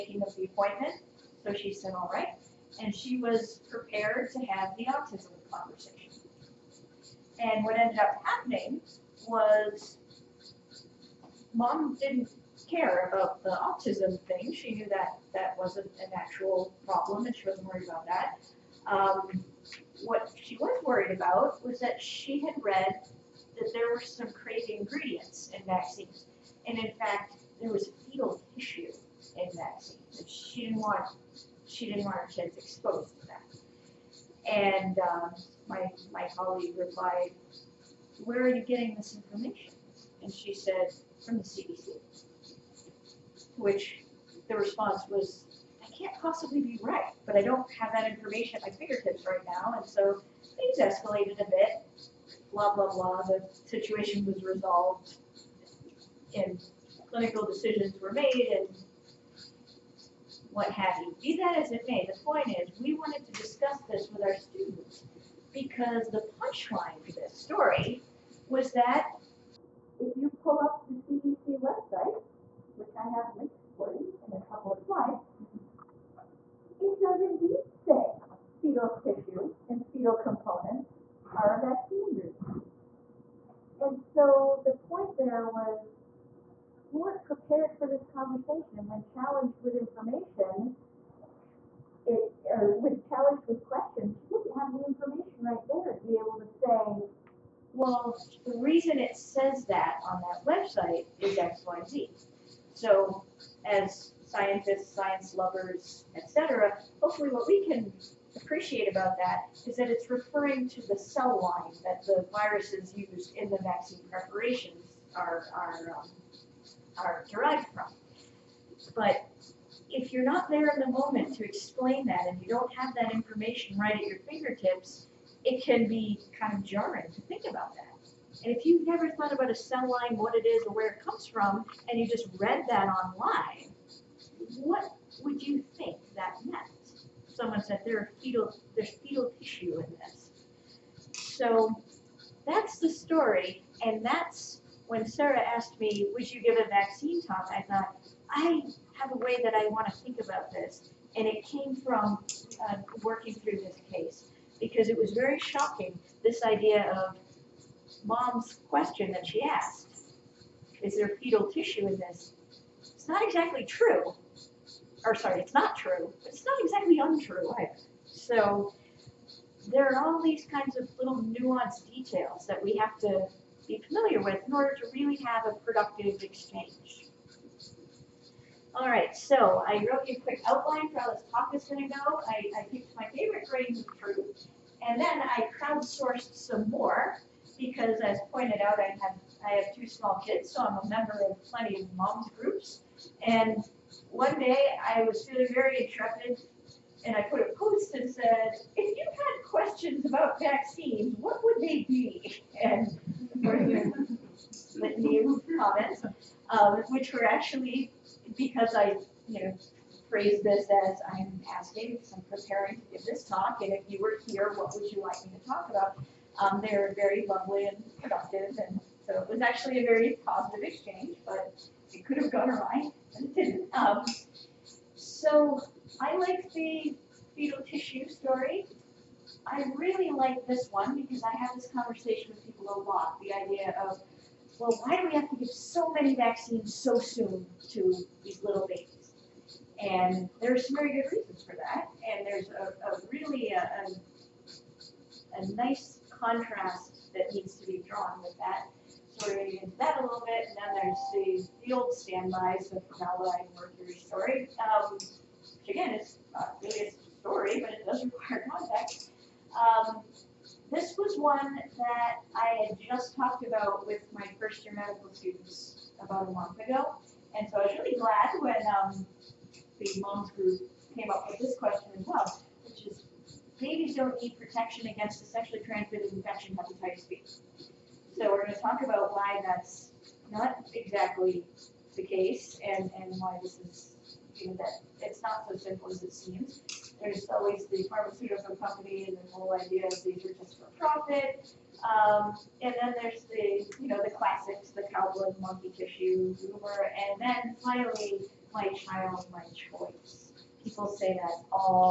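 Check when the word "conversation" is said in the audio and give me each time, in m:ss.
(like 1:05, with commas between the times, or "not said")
0:05, 1:28, 3:51.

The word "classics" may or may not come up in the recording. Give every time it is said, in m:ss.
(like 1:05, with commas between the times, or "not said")
4:54.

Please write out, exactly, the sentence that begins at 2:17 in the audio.
Someone said there fetal, there's fetal tissue in this.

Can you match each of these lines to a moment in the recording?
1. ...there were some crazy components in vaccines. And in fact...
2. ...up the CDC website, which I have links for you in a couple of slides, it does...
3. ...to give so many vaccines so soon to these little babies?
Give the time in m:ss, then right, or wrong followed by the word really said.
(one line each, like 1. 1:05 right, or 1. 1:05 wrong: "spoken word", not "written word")
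1. 0:23 wrong: "ingredients", not "components"
2. 1:10 right
3. 3:55 right.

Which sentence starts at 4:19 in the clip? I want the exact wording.
Um, this was one that I had just talked about with my first year medical students about a month ago.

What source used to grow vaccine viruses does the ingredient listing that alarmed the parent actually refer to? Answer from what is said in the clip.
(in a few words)
the cell line.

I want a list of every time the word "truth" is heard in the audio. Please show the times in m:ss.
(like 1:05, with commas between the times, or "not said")
3:03.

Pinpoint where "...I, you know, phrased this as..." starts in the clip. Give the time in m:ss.
3:28.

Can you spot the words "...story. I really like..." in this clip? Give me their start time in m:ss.
3:48.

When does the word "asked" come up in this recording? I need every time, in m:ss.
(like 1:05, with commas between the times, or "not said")
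2:25, 2:39.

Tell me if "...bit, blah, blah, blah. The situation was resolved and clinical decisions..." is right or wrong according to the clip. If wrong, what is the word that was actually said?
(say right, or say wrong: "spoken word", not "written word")
right.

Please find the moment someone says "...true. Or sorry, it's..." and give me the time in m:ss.
2:43.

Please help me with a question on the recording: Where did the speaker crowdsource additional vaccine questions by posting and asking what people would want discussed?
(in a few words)
moms groups.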